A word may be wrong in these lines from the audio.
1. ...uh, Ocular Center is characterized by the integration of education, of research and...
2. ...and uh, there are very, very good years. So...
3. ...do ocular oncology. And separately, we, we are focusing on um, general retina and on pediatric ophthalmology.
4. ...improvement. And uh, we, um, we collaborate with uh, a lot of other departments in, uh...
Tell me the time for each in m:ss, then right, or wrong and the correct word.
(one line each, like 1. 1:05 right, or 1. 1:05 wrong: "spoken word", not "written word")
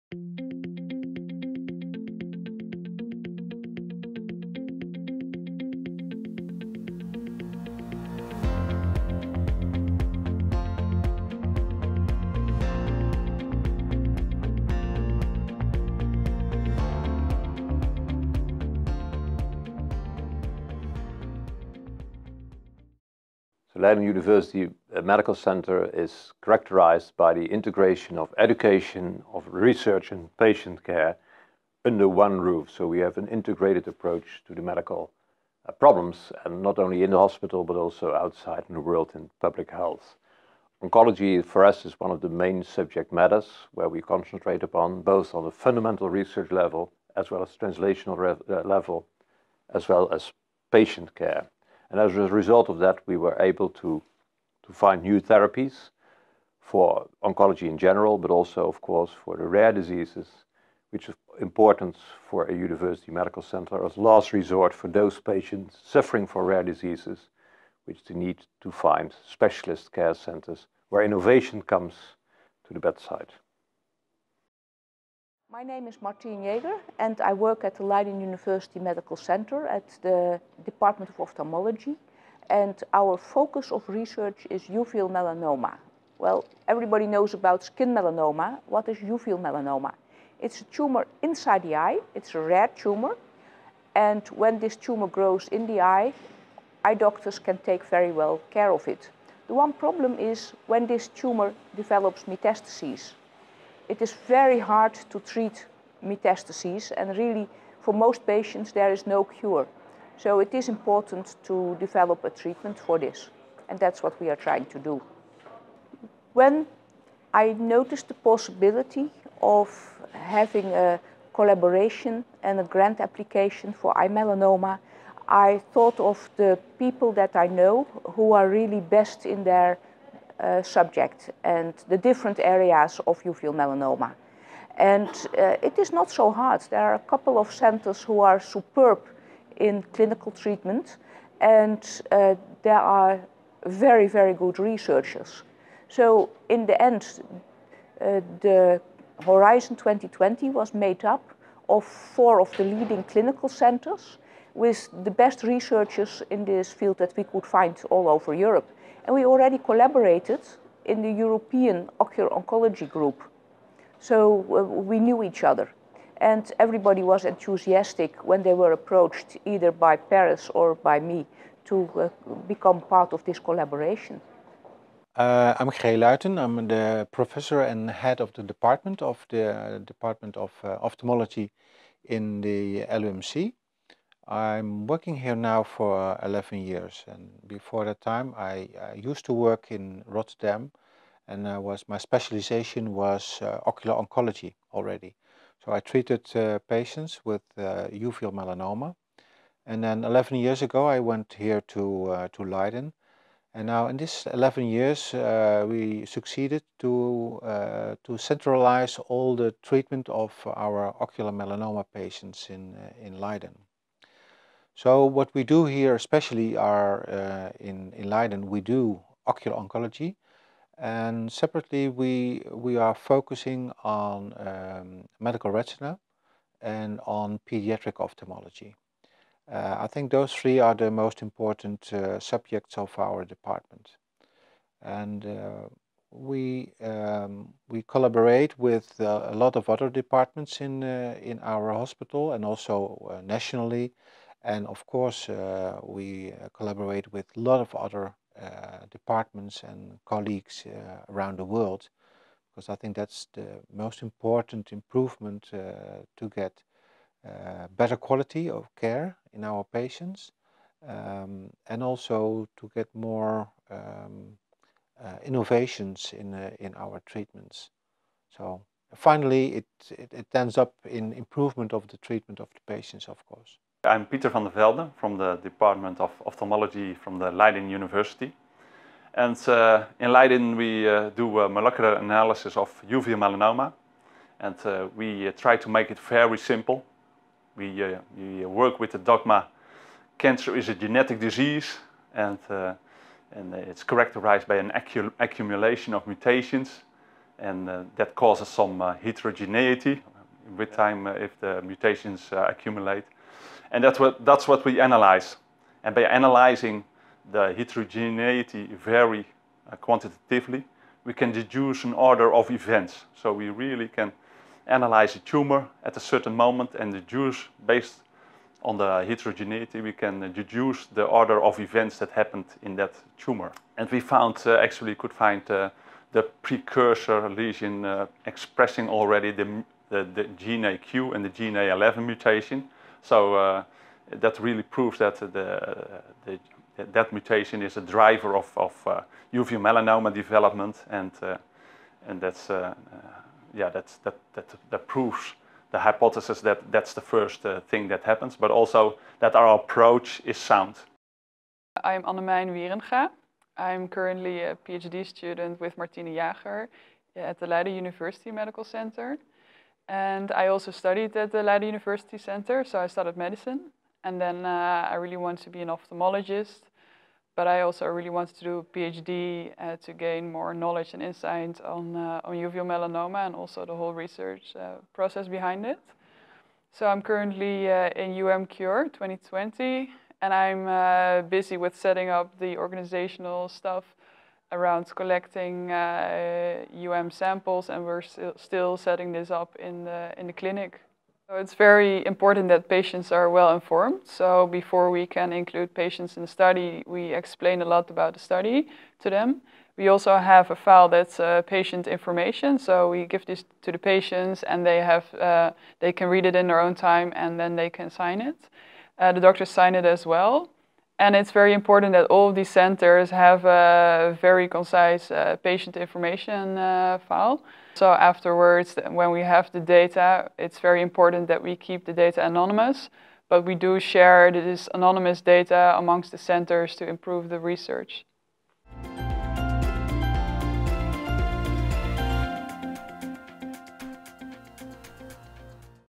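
1. 0:24 wrong: "Medical", not "Ocular"
2. 2:21 wrong: "researchers", not "years"
3. 3:38 wrong: "medical", not "general"
4. 3:53 wrong: "department", not "improvement".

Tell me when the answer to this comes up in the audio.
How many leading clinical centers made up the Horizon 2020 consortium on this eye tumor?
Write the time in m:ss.
2:31.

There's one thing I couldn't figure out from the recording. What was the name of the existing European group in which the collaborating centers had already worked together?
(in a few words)
European Ocular Oncology Group.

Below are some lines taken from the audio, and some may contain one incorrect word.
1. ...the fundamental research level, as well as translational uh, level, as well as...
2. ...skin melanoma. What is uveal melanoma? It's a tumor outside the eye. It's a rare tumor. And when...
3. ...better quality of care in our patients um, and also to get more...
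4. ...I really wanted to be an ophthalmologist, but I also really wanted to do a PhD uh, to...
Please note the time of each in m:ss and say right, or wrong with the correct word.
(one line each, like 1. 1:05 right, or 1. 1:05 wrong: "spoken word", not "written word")
1. 0:45 right
2. 1:27 wrong: "inside", not "outside"
3. 4:17 right
4. 6:04 right.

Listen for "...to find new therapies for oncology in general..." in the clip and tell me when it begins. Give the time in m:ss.
0:53.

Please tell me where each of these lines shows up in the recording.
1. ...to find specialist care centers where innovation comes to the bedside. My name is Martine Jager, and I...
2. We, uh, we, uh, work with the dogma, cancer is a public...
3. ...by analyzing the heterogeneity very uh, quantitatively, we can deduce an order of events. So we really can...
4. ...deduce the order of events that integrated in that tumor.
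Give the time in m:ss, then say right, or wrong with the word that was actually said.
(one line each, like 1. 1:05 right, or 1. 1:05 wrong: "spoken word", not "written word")
1. 1:08 right
2. 4:47 wrong: "genetic", not "public"
3. 5:05 right
4. 5:20 wrong: "happened", not "integrated".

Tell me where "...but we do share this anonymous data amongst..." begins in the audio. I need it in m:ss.
7:03.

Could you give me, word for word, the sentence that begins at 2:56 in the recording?
I'm the professor and head of the department of the uh, Department of uh, Ophthalmology in the LUMC.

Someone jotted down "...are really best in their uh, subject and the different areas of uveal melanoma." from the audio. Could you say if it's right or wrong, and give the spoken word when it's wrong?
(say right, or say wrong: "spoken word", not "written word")
right.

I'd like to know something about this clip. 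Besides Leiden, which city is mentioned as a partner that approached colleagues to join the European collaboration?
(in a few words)
Paris.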